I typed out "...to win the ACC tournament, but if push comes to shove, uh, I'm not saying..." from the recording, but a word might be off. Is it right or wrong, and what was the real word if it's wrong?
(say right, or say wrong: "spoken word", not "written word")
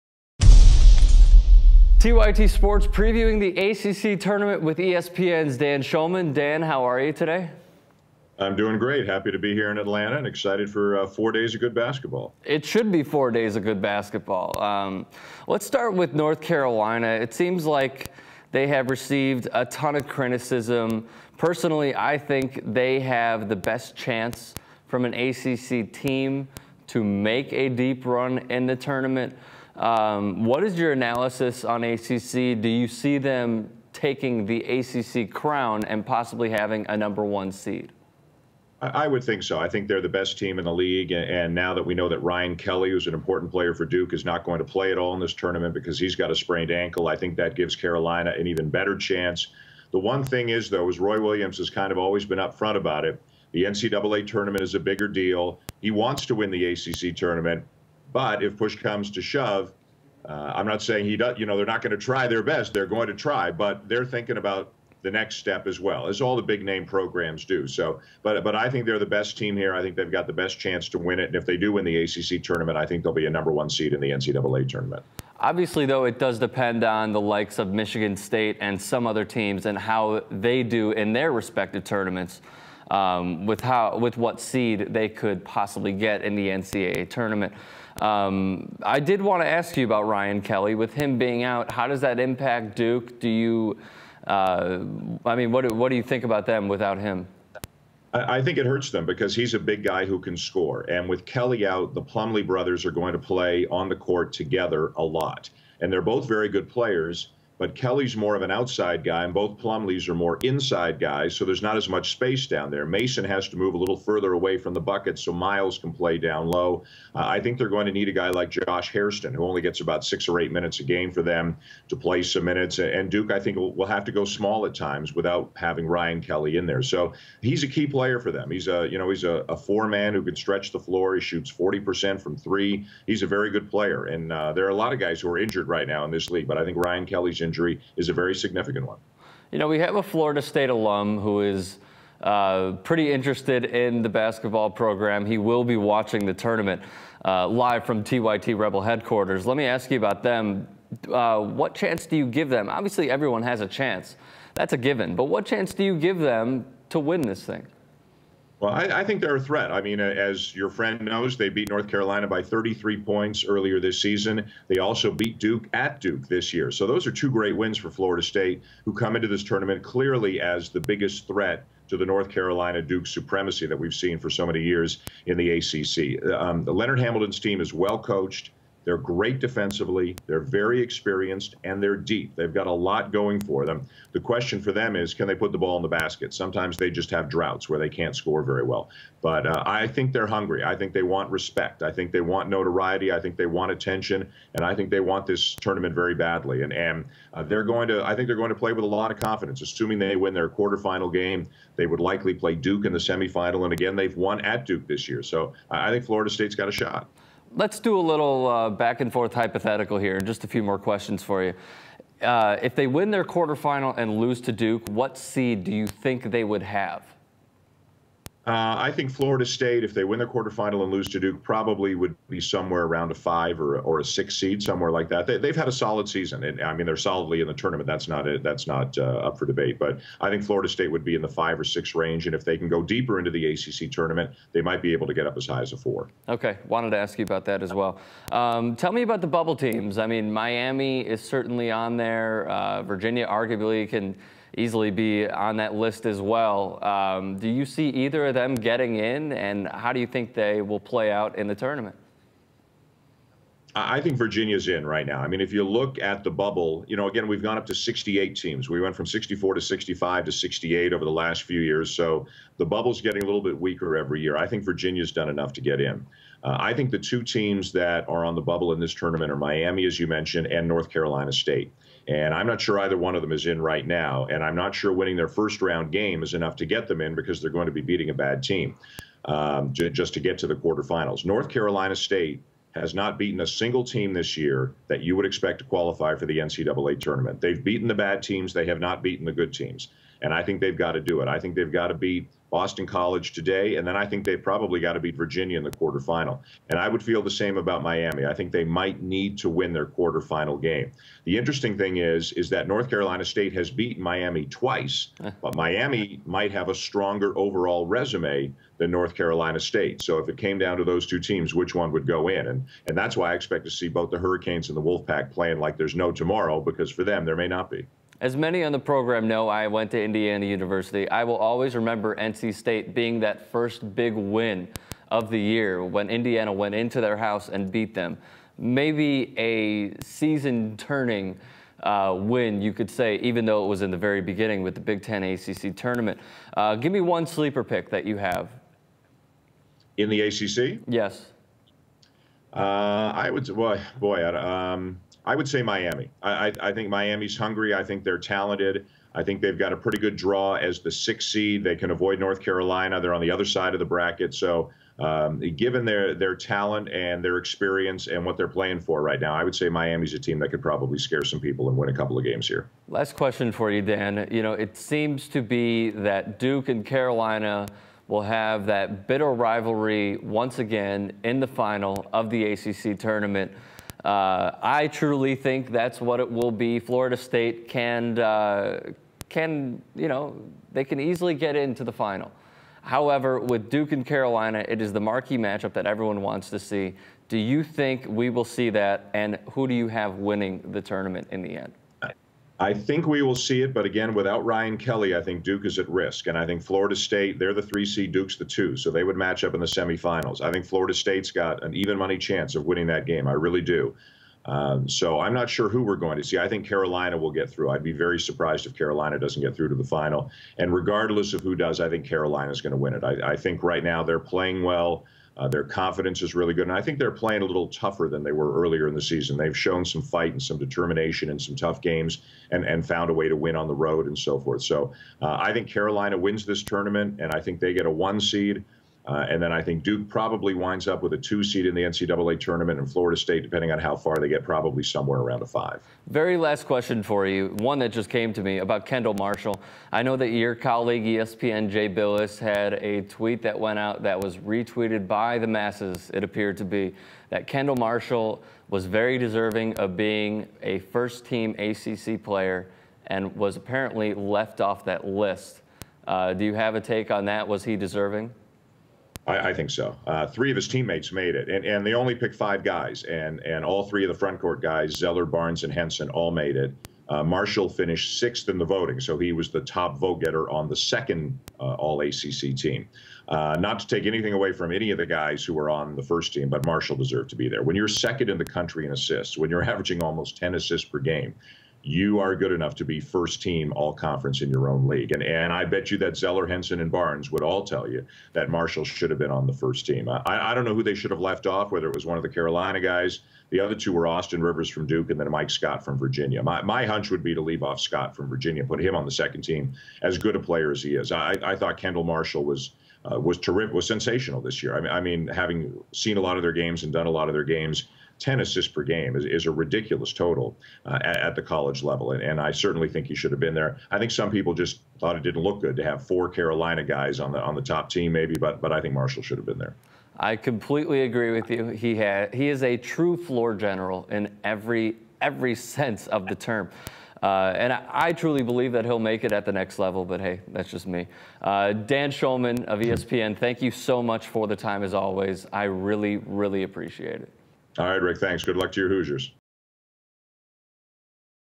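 right.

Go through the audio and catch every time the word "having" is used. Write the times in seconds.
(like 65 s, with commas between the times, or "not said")
36 s, 125 s, 505 s.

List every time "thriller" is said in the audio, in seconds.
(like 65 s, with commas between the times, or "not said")
not said.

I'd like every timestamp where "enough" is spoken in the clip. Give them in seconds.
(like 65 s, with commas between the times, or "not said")
265 s, 276 s, 482 s.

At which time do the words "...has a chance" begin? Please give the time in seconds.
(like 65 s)
153 s.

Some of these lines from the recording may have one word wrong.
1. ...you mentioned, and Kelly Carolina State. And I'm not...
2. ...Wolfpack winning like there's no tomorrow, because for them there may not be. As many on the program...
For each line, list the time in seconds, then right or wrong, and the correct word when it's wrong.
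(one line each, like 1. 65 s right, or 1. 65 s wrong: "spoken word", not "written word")
1. 269 s wrong: "North", not "Kelly"
2. 314 s wrong: "playing", not "winning".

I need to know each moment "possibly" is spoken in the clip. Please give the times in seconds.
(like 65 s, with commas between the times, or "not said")
36 s, 85 s.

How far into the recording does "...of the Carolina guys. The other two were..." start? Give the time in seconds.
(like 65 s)
492 s.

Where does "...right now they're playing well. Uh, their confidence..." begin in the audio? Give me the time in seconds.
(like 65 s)
413 s.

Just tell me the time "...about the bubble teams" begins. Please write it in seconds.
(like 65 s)
239 s.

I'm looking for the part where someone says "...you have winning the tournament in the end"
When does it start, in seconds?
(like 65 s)
389 s.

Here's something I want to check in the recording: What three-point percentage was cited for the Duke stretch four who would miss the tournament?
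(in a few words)
40%.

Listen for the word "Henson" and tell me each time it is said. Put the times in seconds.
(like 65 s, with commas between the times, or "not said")
465 s, 486 s.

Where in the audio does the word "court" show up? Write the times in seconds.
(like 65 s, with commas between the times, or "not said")
103 s, 464 s.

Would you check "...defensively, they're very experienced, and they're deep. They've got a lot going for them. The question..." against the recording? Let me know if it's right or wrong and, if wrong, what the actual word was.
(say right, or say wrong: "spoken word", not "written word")
right.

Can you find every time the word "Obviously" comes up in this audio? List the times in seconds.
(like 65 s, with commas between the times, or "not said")
75 s, 152 s.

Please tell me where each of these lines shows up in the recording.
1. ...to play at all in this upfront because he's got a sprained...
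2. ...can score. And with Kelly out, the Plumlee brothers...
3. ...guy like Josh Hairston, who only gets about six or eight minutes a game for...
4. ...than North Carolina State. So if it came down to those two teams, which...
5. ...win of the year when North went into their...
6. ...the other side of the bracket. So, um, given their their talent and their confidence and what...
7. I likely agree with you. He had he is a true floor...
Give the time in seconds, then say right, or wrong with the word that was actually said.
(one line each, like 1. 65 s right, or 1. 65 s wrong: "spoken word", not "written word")
1. 44 s wrong: "tournament", not "upfront"
2. 100 s right
3. 118 s right
4. 308 s right
5. 324 s wrong: "Indiana", not "North"
6. 353 s wrong: "experience", not "confidence"
7. 520 s wrong: "completely", not "likely".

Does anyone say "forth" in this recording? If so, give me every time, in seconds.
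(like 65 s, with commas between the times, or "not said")
209 s, 424 s.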